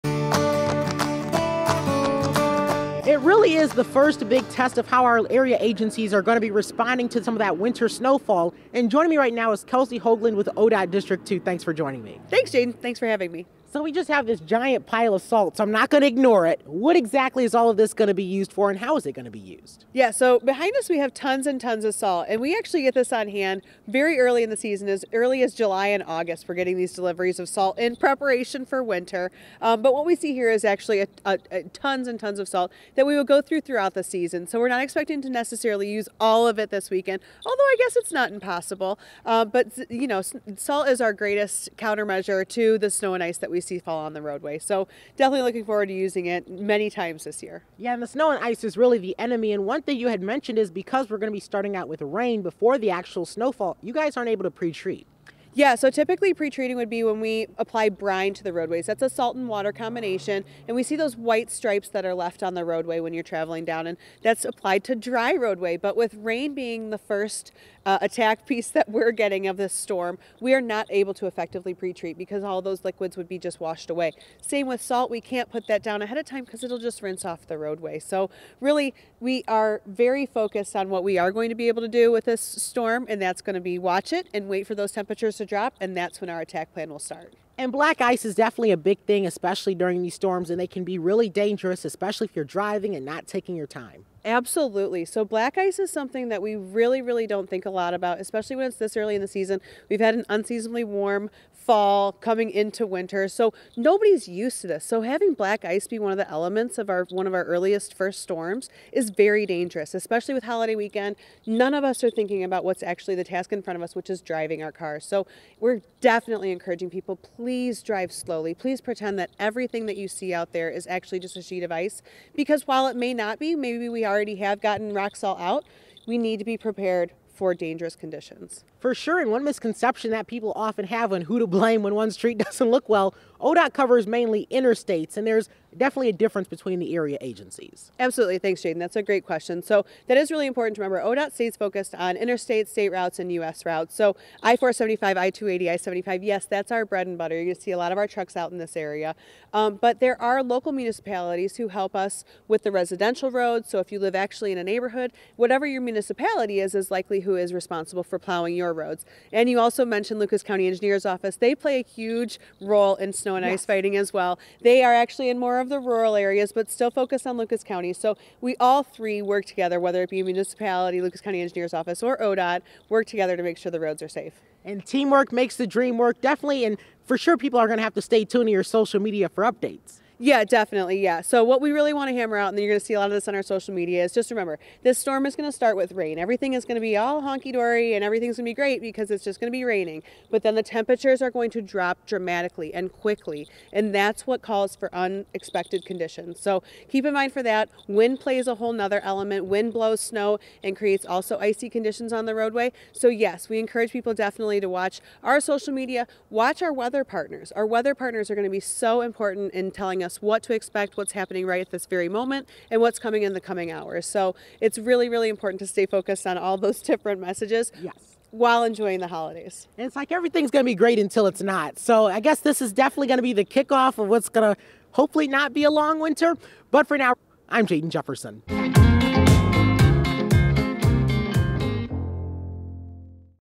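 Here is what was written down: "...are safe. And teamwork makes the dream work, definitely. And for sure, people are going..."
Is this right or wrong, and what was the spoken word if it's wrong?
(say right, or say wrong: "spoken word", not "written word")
right.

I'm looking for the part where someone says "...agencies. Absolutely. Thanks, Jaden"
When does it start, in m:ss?
2:17.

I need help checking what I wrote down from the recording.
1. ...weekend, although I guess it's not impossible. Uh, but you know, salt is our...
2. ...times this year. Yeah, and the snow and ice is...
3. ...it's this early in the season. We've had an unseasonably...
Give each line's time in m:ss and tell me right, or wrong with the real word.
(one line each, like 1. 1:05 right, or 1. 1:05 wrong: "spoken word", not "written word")
1. 0:36 right
2. 0:46 right
3. 1:38 right.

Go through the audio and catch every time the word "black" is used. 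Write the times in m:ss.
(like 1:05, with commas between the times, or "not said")
1:27, 1:35, 1:45.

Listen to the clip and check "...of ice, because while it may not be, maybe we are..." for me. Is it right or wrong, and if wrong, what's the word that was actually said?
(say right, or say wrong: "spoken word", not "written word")
right.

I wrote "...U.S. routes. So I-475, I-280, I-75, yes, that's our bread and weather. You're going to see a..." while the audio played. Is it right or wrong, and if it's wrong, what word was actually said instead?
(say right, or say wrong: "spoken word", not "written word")
wrong: "butter", not "weather".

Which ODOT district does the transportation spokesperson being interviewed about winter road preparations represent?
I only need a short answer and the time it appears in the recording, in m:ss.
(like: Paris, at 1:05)
District 2, at 0:10.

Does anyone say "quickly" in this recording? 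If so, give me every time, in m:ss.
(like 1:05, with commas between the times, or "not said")
3:12.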